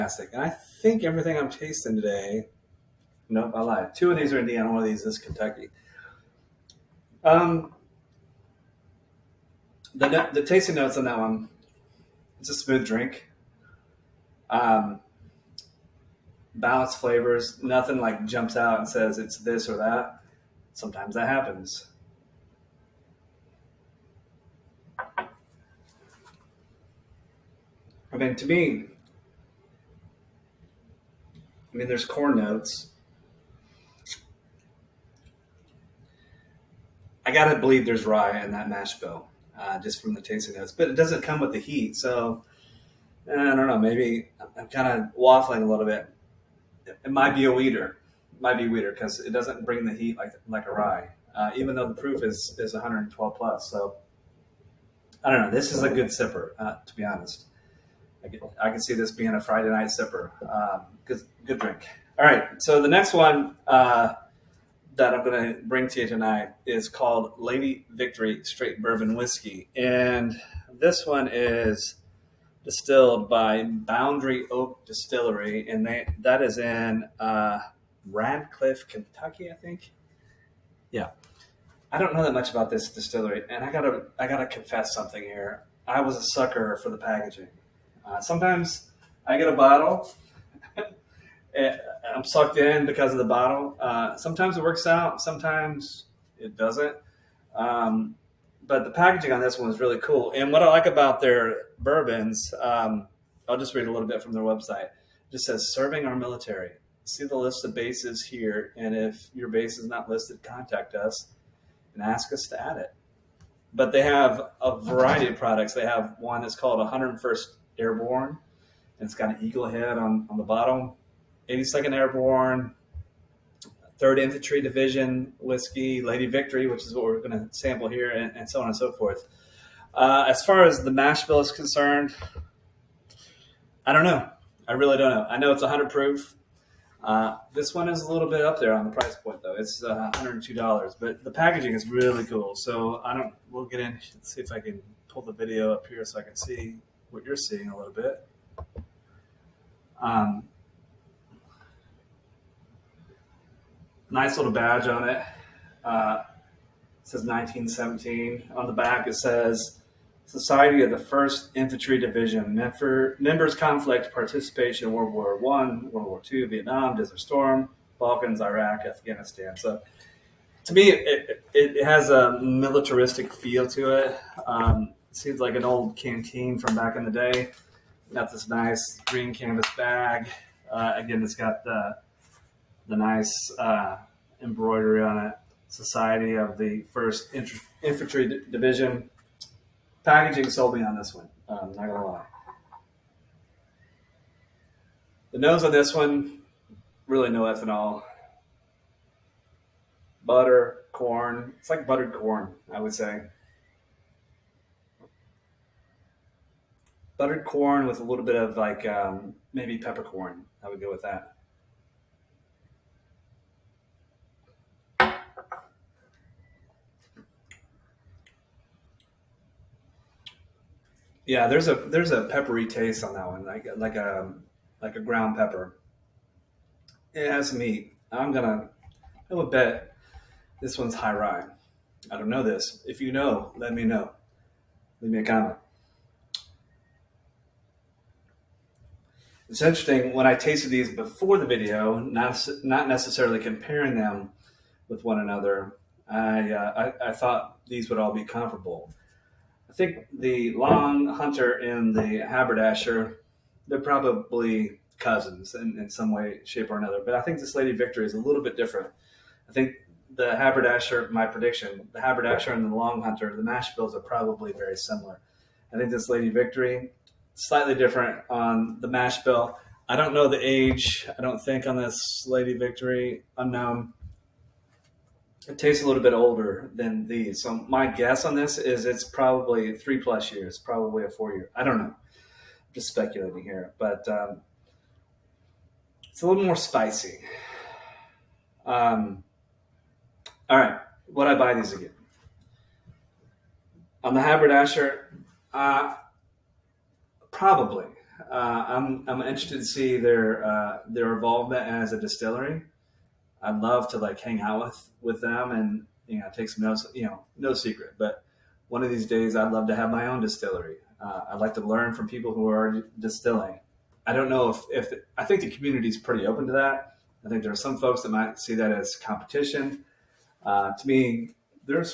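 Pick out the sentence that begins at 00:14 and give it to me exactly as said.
Um, balanced flavors, nothing like jumps out and says it's this or that.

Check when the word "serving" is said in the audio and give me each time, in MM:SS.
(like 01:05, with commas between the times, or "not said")
01:45.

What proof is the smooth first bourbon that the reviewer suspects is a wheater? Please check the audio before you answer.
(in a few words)
112.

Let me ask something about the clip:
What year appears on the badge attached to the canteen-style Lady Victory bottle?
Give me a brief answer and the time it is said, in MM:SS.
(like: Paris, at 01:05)
1917, at 02:37.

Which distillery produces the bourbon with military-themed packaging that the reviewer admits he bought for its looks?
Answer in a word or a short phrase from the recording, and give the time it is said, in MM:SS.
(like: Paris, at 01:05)
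Boundary Oak Distillery, at 01:13.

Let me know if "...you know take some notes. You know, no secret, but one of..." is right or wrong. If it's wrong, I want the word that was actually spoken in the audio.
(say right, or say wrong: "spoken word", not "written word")
right.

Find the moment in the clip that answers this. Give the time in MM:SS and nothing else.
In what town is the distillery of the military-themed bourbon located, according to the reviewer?
01:18.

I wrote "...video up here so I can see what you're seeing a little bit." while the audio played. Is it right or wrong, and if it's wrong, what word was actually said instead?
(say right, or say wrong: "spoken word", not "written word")
right.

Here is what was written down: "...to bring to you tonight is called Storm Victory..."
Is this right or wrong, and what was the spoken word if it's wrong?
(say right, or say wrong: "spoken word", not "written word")
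wrong: "Lady", not "Storm".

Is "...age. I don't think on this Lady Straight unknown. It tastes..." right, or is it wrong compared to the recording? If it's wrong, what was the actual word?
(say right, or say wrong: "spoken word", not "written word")
wrong: "Victory", not "Straight".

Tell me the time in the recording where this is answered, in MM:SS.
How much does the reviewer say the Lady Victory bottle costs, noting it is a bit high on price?
02:20.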